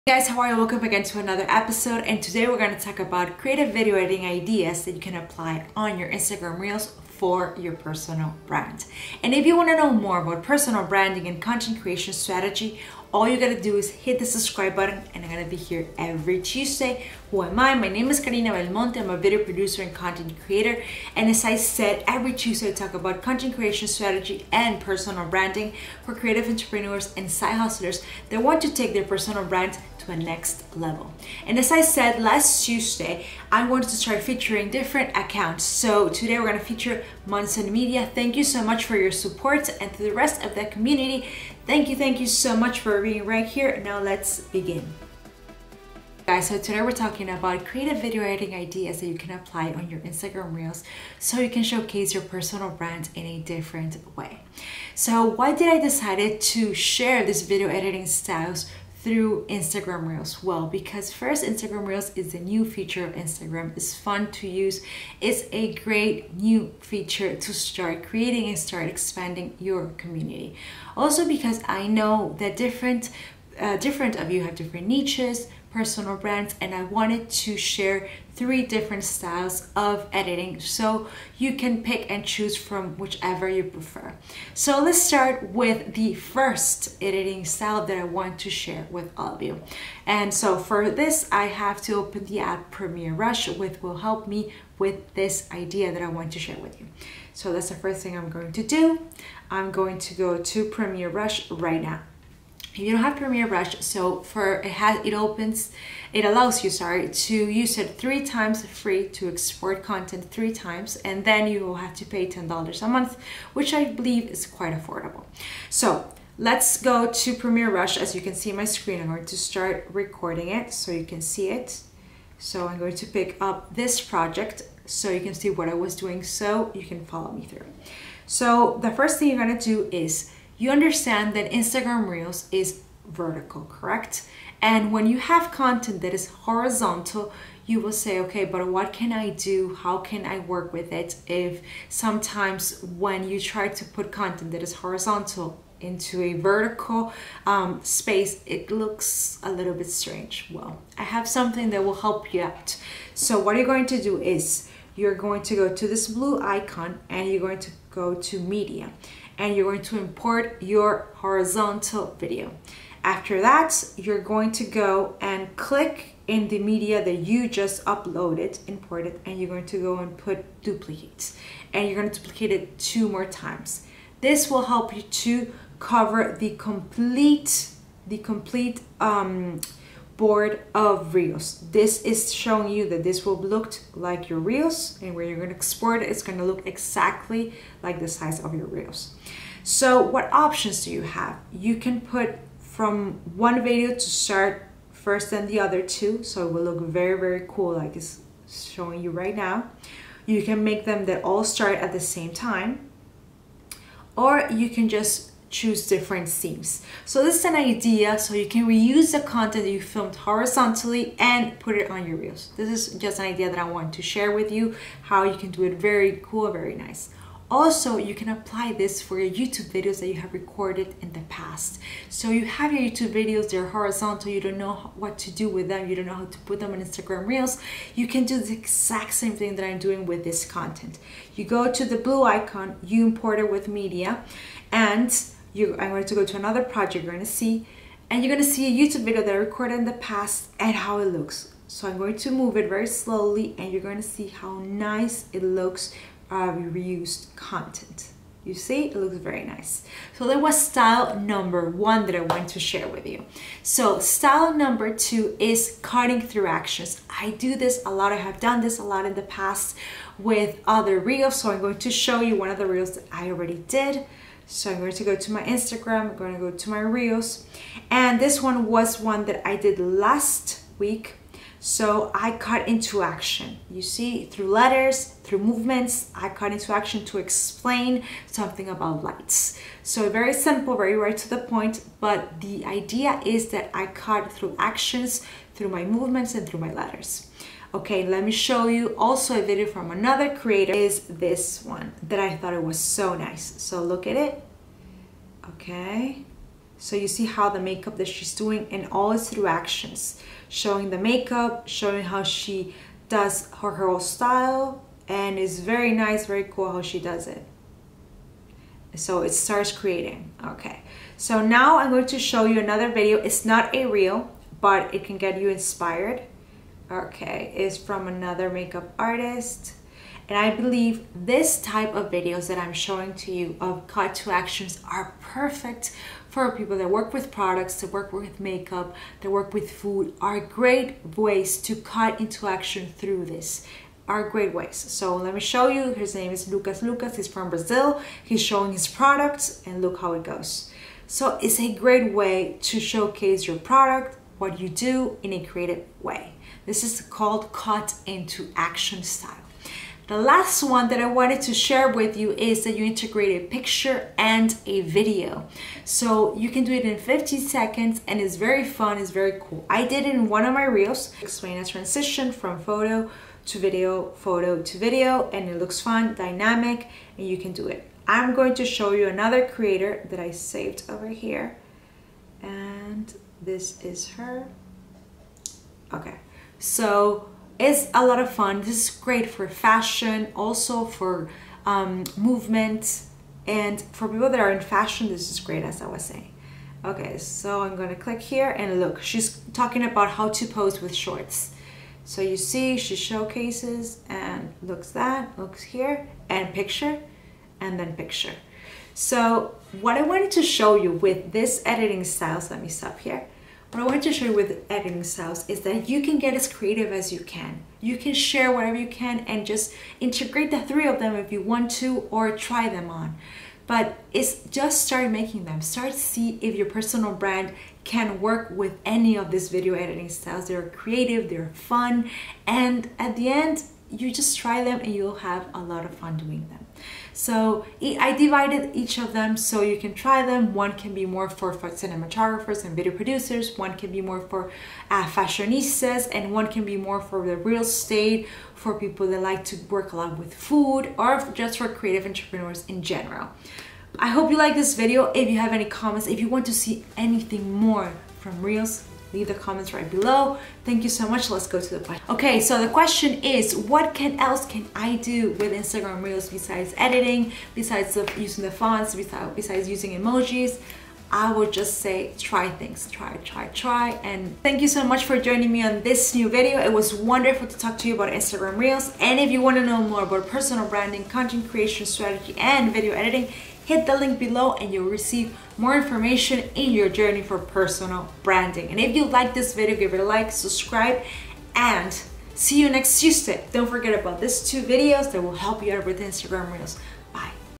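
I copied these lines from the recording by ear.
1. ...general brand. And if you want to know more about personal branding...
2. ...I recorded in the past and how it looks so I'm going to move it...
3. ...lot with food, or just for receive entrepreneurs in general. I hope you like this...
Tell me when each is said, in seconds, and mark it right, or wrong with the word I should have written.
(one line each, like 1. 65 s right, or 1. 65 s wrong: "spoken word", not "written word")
1. 7 s wrong: "personal", not "general"
2. 239 s right
3. 439 s wrong: "creative", not "receive".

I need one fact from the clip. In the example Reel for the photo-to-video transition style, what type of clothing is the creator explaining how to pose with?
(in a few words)
Shorts.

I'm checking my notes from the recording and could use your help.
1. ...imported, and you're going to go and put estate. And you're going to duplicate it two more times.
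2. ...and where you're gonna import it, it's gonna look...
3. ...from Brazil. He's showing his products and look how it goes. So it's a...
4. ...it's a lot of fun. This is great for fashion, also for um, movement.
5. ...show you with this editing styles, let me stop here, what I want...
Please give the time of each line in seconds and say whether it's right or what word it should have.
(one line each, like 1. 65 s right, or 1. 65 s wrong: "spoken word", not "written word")
1. 168 s wrong: "duplicate", not "estate"
2. 185 s wrong: "export", not "import"
3. 337 s right
4. 377 s right
5. 400 s right.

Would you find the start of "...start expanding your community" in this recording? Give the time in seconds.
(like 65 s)
68 s.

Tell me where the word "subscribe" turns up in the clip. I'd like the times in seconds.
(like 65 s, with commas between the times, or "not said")
14 s, 480 s.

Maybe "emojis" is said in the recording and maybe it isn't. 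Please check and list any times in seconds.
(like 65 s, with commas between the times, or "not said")
459 s.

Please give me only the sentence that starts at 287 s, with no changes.
Okay, let me show you also a video from another creator is this one that I thought it was so nice.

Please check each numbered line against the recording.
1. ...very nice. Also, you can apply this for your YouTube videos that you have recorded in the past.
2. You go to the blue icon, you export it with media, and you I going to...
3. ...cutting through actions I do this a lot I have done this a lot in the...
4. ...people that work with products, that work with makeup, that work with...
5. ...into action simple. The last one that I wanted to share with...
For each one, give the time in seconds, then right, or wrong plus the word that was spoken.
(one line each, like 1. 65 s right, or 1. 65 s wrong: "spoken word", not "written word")
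1. 216 s right
2. 231 s wrong: "import", not "export"
3. 255 s right
4. 326 s right
5. 348 s wrong: "style", not "simple".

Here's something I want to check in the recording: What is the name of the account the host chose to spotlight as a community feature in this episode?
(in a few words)
Monson Media.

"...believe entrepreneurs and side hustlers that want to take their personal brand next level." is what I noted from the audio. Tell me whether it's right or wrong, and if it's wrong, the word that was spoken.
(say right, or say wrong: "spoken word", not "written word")
wrong: "creative", not "believe".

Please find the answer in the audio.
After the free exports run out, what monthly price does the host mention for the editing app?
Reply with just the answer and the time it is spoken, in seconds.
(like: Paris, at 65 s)
$10, at 112 s.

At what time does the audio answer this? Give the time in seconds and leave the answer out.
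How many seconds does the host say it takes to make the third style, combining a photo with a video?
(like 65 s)
356 s.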